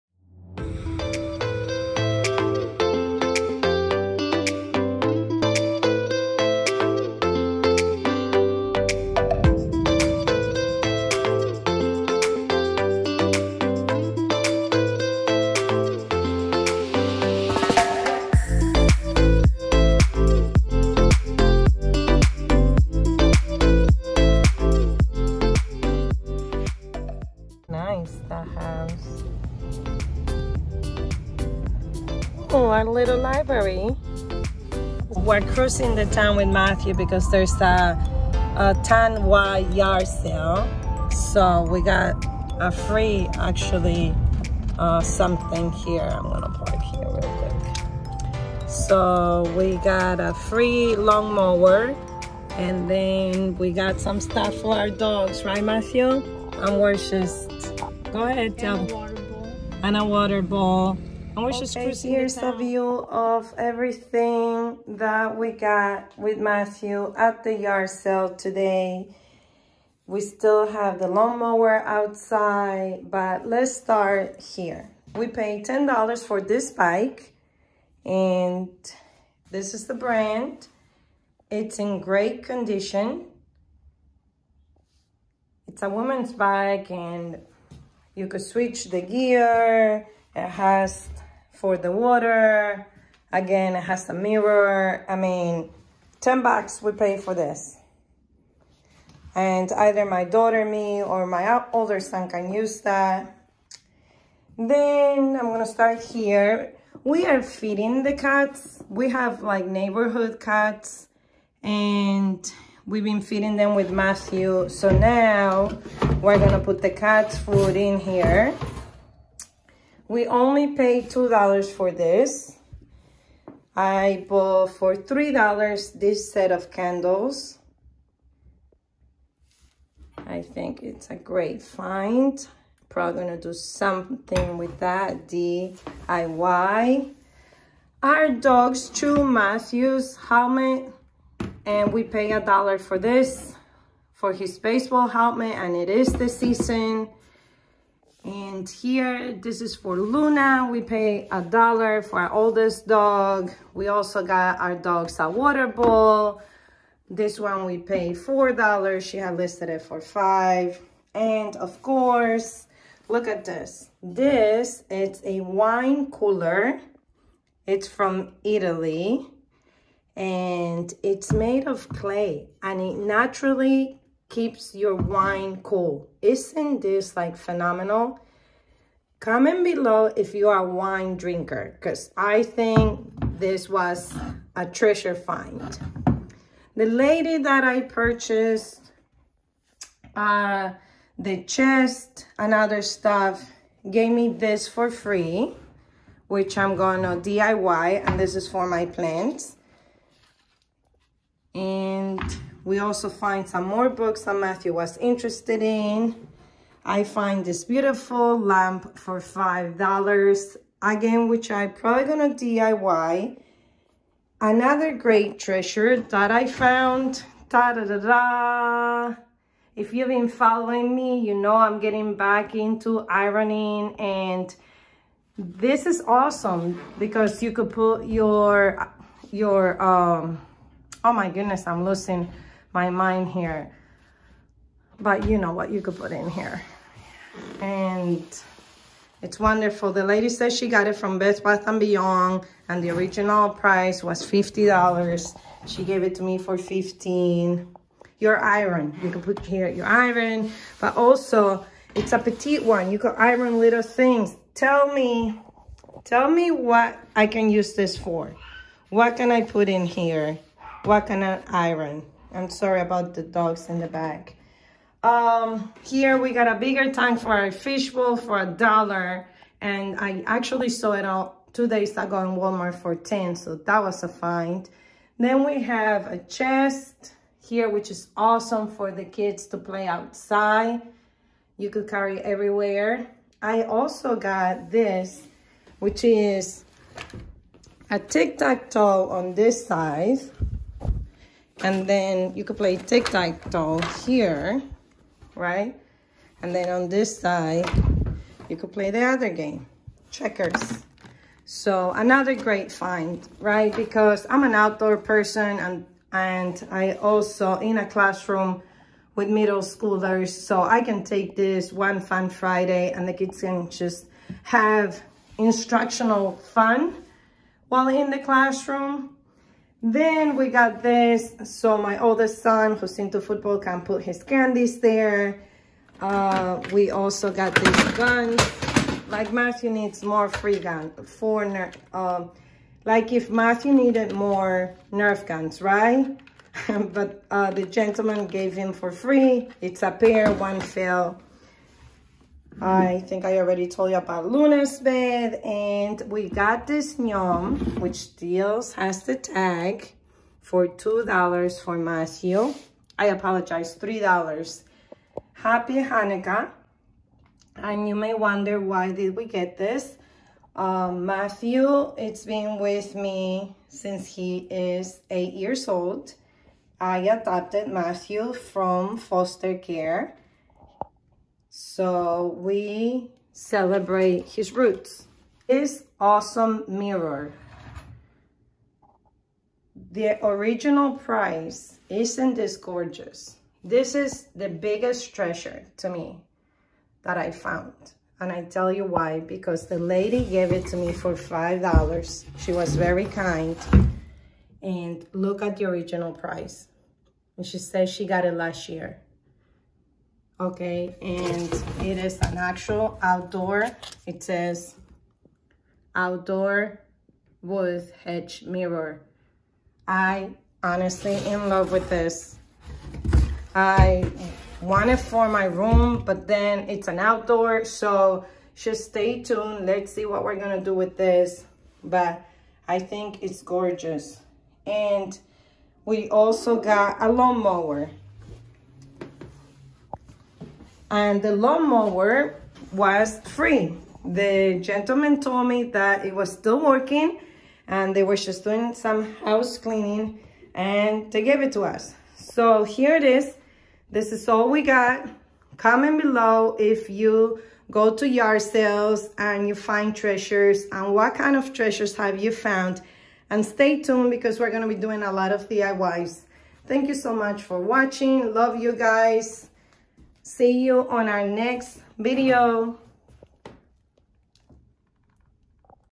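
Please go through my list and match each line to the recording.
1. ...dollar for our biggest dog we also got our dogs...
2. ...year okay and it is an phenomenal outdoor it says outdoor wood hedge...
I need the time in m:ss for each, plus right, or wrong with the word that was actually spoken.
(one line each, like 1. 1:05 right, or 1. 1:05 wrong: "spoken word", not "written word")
1. 2:31 wrong: "oldest", not "biggest"
2. 6:38 wrong: "actual", not "phenomenal".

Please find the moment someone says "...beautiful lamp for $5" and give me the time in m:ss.
3:27.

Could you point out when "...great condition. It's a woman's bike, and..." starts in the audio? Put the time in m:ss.
1:22.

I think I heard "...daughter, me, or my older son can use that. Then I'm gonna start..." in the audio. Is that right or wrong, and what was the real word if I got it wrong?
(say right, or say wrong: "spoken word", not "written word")
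right.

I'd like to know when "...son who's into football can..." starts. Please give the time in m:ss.
5:22.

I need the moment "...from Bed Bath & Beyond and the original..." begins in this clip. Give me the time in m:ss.
4:00.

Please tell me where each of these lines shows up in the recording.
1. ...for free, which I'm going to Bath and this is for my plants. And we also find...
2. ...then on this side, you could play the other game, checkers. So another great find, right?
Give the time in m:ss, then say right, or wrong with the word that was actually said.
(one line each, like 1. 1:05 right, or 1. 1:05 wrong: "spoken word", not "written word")
1. 3:14 wrong: "DIY", not "Bath"
2. 4:56 right.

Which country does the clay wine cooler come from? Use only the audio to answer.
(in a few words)
Italy.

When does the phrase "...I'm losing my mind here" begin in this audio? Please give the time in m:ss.
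3:51.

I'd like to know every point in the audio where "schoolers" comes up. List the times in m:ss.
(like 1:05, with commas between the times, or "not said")
5:09.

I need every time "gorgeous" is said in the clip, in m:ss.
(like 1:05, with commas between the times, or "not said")
6:22, 7:03.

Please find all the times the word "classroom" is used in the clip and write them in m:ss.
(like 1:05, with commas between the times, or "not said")
5:07, 5:18.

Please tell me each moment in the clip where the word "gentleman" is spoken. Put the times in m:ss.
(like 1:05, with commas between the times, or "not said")
5:37, 7:14.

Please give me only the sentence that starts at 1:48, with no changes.
We have like neighborhood cats and We've been feeding them with Matthew.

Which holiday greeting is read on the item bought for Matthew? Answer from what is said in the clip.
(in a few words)
Happy Hanukkah.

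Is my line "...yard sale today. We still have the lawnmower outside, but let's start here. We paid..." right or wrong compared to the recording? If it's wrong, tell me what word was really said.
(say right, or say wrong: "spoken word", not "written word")
right.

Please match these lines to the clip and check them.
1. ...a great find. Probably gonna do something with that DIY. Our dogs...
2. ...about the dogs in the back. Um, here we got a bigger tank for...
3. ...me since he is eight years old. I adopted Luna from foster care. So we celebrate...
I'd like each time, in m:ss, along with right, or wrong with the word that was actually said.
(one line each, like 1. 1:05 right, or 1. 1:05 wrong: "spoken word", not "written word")
1. 2:11 right
2. 4:22 right
3. 6:02 wrong: "Matthew", not "Luna".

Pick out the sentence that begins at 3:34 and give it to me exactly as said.
Another great treasure that I found.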